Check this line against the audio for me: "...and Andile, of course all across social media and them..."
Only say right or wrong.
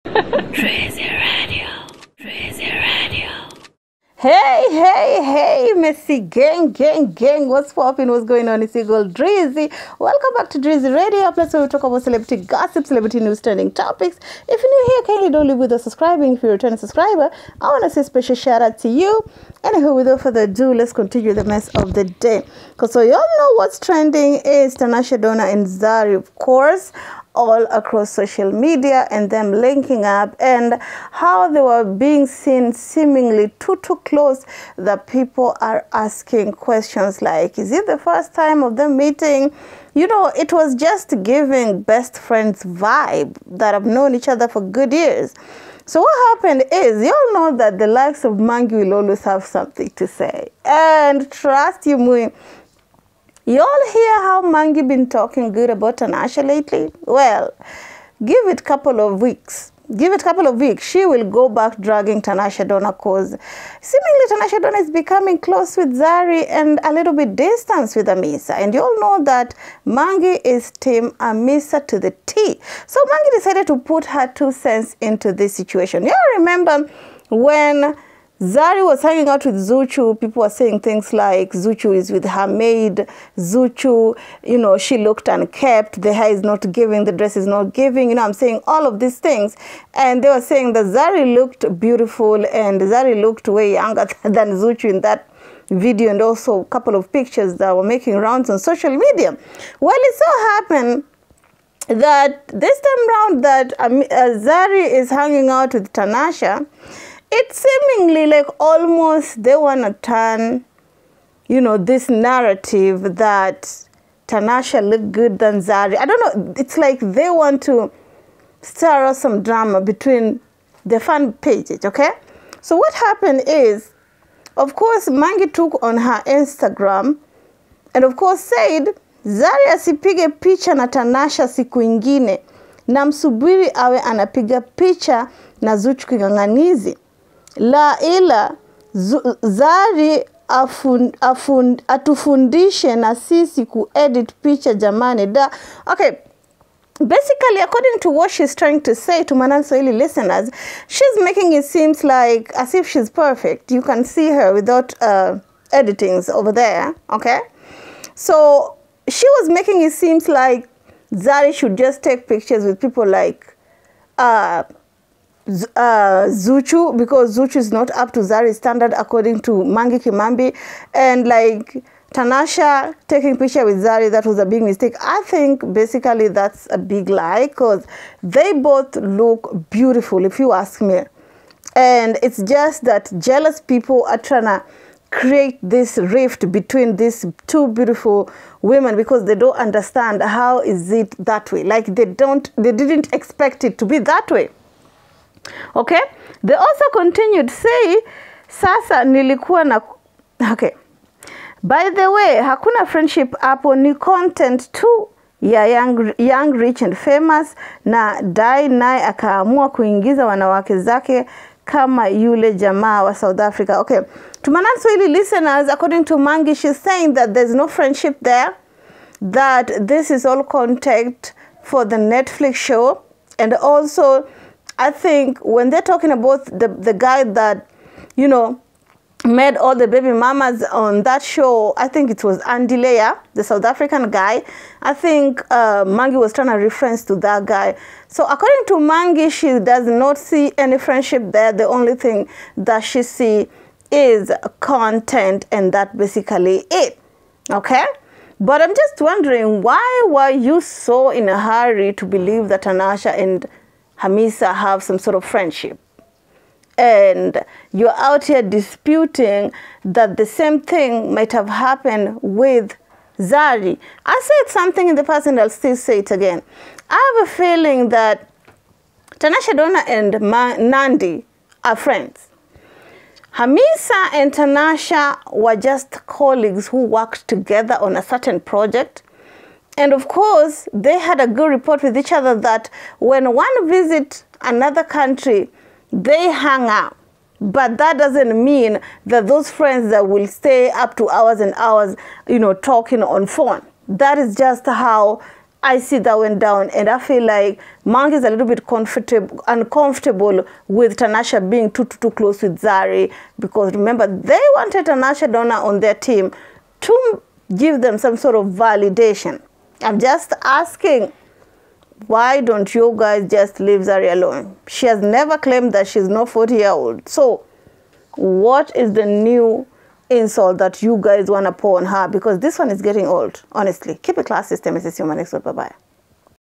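wrong.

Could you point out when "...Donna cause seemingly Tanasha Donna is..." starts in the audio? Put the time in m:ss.
1:02.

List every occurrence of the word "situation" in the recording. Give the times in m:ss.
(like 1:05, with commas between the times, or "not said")
1:15.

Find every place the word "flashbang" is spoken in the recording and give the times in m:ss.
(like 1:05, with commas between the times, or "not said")
not said.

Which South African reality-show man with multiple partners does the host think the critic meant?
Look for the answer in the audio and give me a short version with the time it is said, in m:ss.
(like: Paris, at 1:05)
Andile, at 3:52.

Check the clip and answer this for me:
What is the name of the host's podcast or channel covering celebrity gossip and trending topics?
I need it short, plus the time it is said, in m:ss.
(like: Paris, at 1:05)
Drezzy Radio, at 0:10.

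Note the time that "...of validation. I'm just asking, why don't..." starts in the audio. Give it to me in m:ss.
5:08.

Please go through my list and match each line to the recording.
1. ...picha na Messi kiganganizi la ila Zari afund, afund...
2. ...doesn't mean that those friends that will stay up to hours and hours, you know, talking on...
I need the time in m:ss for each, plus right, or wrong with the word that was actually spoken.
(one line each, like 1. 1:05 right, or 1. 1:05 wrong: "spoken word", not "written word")
1. 2:14 wrong: "Zuchu", not "Messi"
2. 4:47 right.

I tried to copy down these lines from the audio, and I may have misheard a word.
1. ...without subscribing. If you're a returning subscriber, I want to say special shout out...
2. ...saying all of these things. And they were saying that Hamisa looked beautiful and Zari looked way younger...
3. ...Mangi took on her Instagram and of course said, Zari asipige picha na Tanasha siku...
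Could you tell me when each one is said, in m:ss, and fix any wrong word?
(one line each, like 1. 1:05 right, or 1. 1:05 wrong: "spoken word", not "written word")
1. 0:15 right
2. 1:28 wrong: "Zari", not "Hamisa"
3. 2:05 right.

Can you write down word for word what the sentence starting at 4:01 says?
The only thing that she see is content and that basically it.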